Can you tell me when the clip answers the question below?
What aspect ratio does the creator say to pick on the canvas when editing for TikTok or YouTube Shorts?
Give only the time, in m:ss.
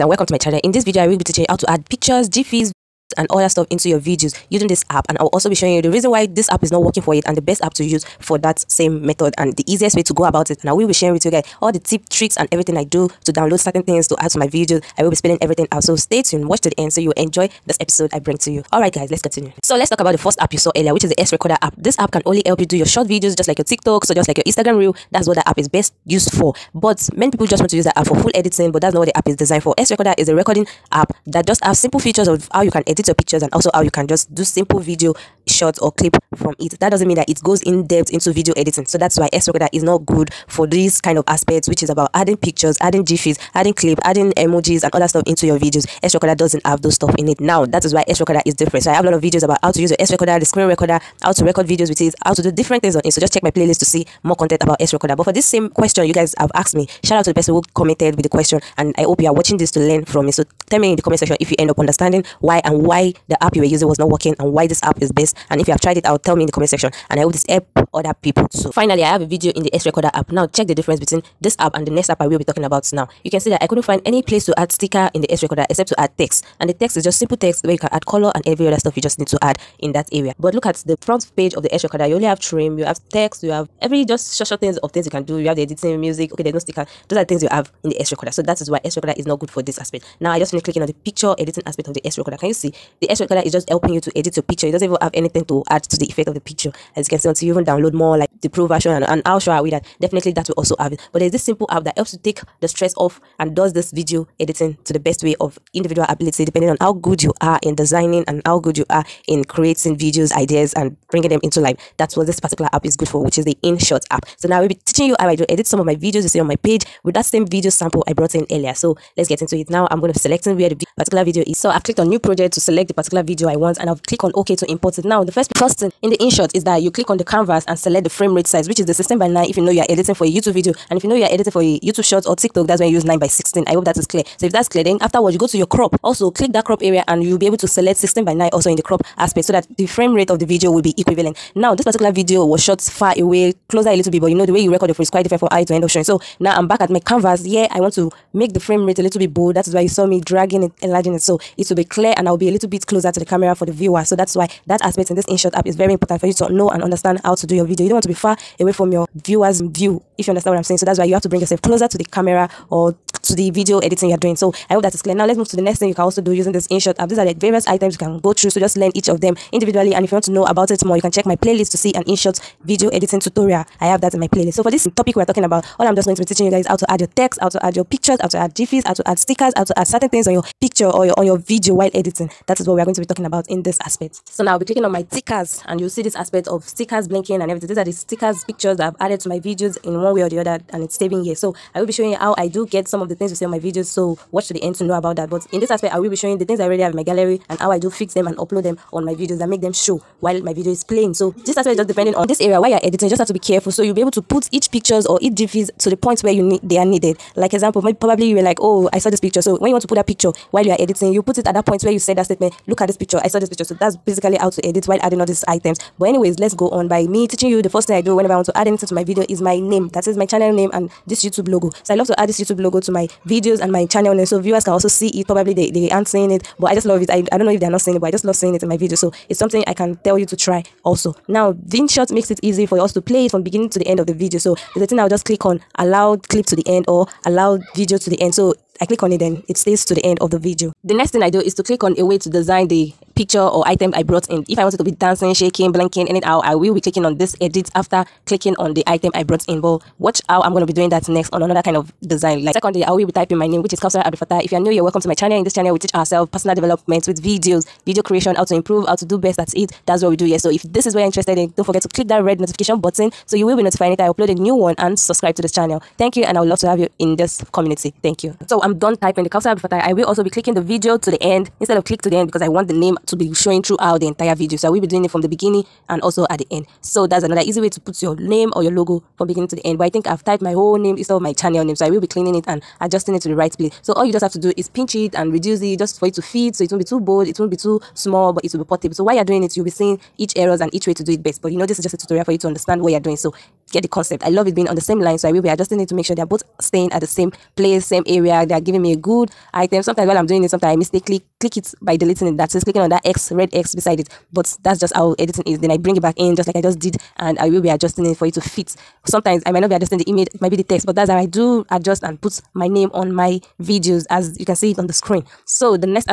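2:13.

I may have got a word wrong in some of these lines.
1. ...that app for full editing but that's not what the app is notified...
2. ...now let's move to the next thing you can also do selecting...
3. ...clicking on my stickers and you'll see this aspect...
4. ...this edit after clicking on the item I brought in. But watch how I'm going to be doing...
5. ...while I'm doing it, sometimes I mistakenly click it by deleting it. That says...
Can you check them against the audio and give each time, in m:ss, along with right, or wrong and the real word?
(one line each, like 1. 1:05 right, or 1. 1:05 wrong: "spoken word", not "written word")
1. 0:27 wrong: "designed", not "notified"
2. 2:45 wrong: "using", not "selecting"
3. 3:04 right
4. 4:07 right
5. 5:00 right.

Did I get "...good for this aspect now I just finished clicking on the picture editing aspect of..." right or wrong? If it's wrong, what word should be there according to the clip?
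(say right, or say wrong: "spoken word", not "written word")
right.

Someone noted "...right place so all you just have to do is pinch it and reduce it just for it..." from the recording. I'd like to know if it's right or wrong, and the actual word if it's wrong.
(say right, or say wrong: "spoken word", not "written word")
right.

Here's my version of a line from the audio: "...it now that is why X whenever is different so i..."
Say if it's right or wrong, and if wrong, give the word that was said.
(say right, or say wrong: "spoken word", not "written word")
wrong: "recorder", not "whenever".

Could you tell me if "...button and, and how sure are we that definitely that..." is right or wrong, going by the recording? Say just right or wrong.
wrong.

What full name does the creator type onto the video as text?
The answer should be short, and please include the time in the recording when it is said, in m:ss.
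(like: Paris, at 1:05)
Kaosarah Fatah, at 4:13.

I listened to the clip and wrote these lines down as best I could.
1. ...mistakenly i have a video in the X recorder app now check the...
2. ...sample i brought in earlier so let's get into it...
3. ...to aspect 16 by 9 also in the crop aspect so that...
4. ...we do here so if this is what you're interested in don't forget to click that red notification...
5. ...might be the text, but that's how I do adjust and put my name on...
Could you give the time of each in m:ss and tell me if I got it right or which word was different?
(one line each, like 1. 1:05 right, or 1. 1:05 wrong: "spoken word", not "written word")
1. 1:08 wrong: "finally", not "mistakenly"
2. 1:57 right
3. 2:17 wrong: "select", not "aspect"
4. 4:20 right
5. 5:10 right.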